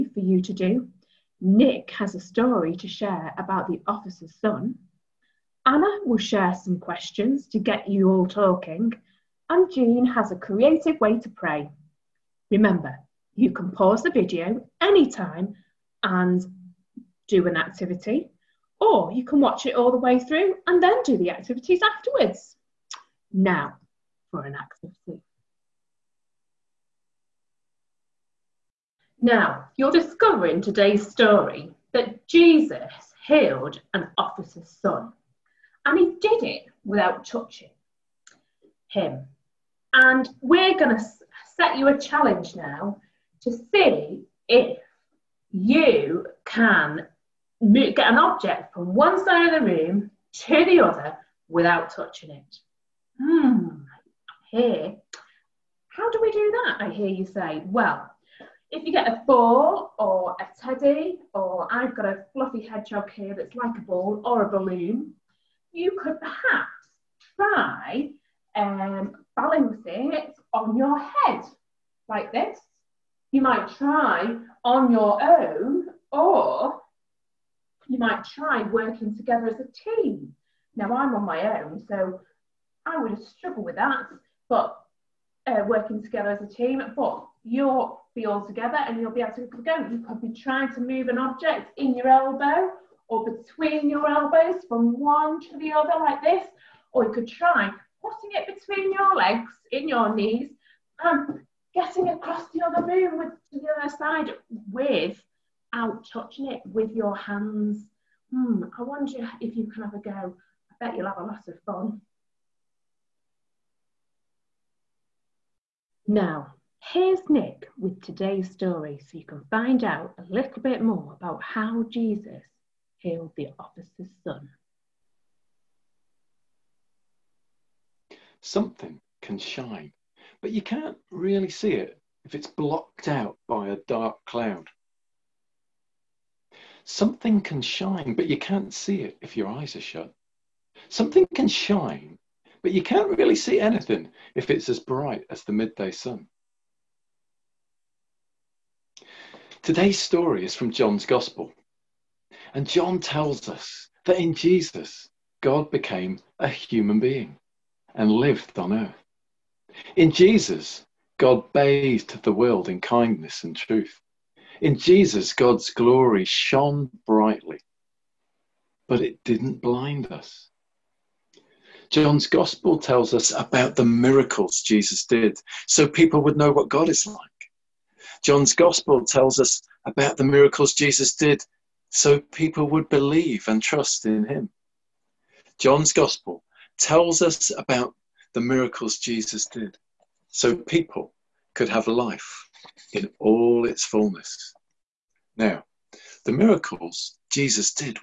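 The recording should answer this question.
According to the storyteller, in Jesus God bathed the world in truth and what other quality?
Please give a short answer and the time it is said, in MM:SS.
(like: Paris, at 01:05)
kindness, at 02:42.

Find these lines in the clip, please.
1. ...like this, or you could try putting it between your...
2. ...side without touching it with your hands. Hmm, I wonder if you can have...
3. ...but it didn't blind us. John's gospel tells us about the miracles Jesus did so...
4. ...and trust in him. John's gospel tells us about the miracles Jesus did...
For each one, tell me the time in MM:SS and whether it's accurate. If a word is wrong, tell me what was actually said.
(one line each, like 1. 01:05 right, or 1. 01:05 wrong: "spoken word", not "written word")
1. 01:36 right
2. 01:43 right
3. 02:48 right
4. 03:03 right.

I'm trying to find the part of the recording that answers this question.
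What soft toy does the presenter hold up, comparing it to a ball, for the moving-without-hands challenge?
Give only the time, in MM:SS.
01:02.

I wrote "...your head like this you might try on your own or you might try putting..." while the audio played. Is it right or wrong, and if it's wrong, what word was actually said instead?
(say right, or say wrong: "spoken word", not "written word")
wrong: "working", not "putting".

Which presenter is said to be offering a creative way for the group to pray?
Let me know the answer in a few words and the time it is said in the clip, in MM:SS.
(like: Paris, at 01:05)
Jean, at 00:09.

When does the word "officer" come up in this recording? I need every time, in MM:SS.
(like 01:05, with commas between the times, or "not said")
00:03, 00:34, 02:03.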